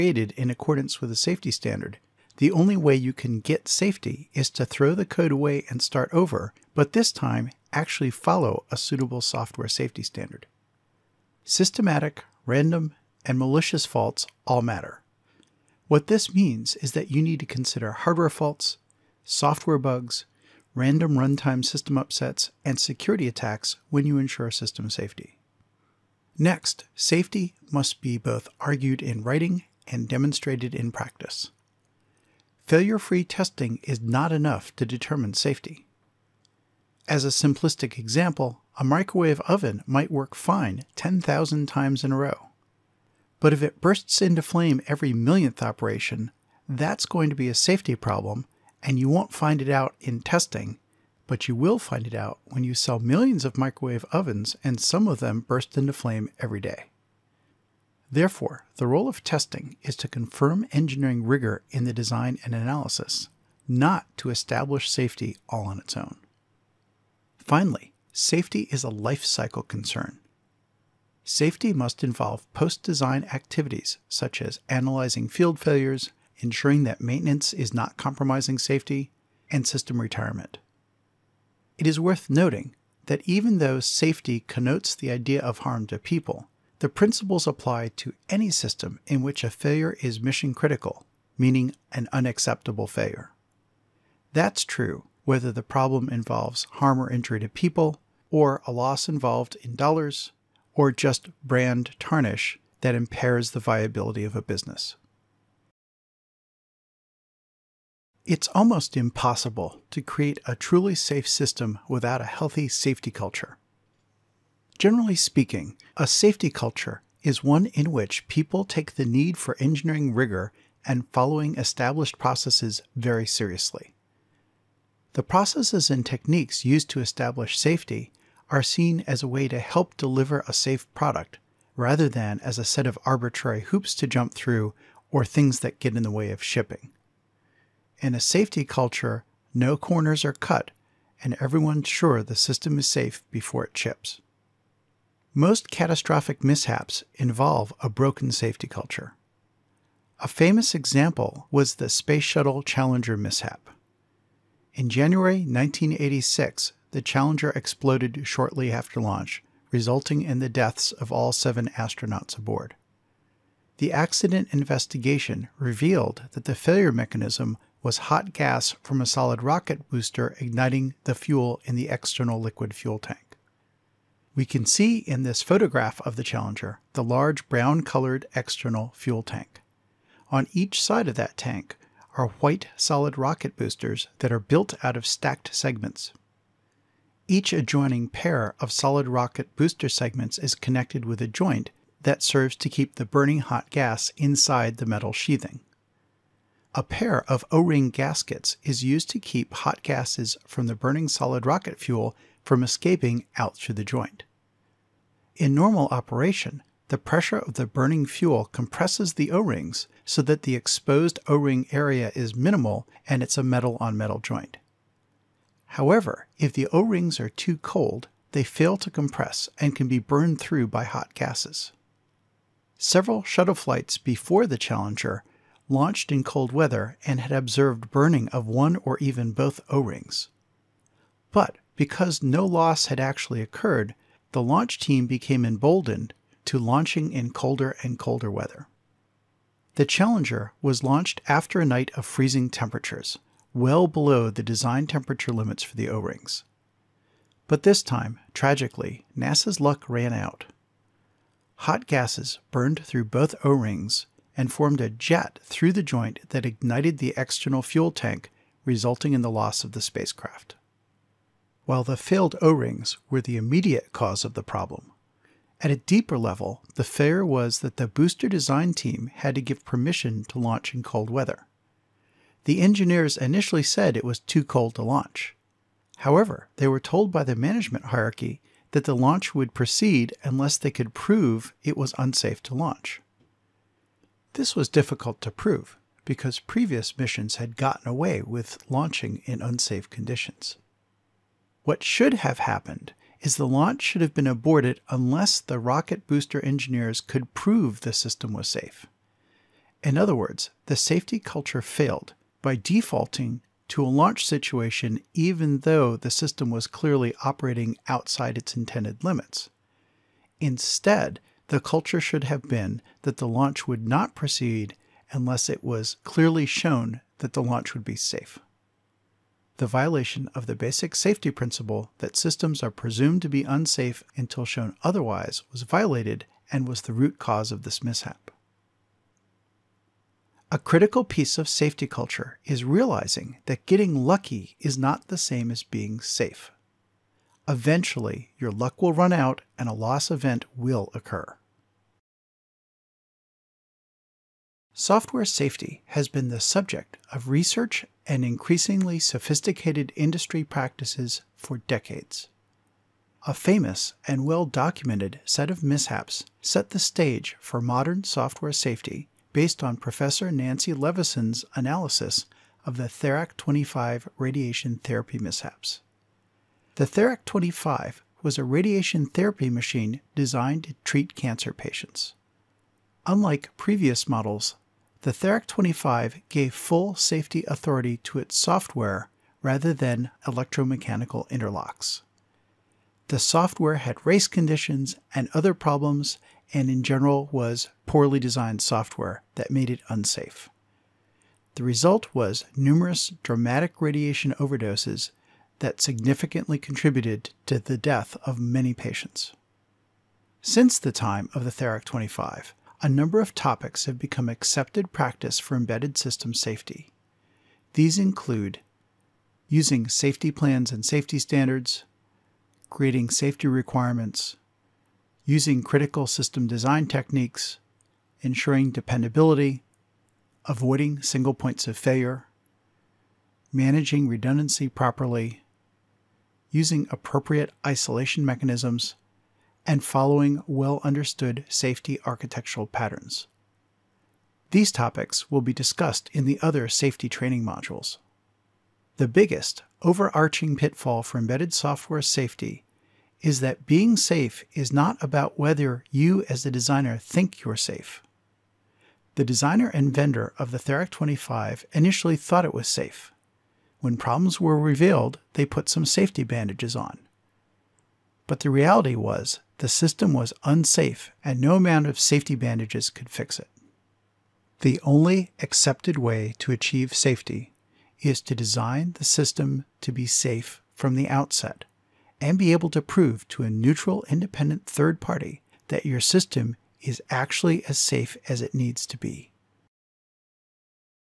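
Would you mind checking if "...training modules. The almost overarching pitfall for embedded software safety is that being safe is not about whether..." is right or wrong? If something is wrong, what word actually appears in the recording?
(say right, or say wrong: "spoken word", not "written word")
wrong: "biggest", not "almost".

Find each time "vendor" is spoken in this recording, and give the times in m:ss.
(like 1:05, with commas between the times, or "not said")
7:29.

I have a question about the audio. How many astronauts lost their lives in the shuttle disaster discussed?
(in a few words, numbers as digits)
7.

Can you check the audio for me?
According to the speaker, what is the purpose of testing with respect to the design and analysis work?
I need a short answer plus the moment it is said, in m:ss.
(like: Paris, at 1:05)
confirm engineering rigor, at 1:00.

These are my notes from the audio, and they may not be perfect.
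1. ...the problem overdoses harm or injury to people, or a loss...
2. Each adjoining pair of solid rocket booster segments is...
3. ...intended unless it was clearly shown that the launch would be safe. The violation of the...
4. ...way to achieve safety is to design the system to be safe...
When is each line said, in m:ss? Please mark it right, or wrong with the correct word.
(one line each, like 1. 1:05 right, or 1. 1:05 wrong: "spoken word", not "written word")
1. 1:35 wrong: "involves", not "overdoses"
2. 3:07 right
3. 5:14 wrong: "proceed", not "intended"
4. 7:45 right.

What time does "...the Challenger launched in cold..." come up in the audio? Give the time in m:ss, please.
3:44.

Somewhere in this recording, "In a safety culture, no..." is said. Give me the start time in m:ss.
2:18.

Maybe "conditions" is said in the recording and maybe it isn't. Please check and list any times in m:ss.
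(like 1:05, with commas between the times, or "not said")
4:49, 6:24.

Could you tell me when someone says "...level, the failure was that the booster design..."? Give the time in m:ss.
4:26.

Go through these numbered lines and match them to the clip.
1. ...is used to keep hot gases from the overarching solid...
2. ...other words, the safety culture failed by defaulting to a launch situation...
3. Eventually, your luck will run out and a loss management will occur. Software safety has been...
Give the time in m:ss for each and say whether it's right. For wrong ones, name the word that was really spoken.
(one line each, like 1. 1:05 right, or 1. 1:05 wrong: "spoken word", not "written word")
1. 3:18 wrong: "burning", not "overarching"
2. 4:59 right
3. 5:37 wrong: "event", not "management".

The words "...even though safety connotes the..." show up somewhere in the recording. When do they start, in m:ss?
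1:23.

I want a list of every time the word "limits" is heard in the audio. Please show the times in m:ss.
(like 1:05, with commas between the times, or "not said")
4:05, 5:09.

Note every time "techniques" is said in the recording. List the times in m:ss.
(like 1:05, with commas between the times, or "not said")
2:06, 6:56.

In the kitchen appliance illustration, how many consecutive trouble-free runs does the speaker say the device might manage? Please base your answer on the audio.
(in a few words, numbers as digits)
10,000.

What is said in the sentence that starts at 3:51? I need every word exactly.
But because no loss had actually occurred, the launch team became emboldened to launching in colder and colder weather.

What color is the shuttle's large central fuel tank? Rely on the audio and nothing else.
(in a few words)
brown.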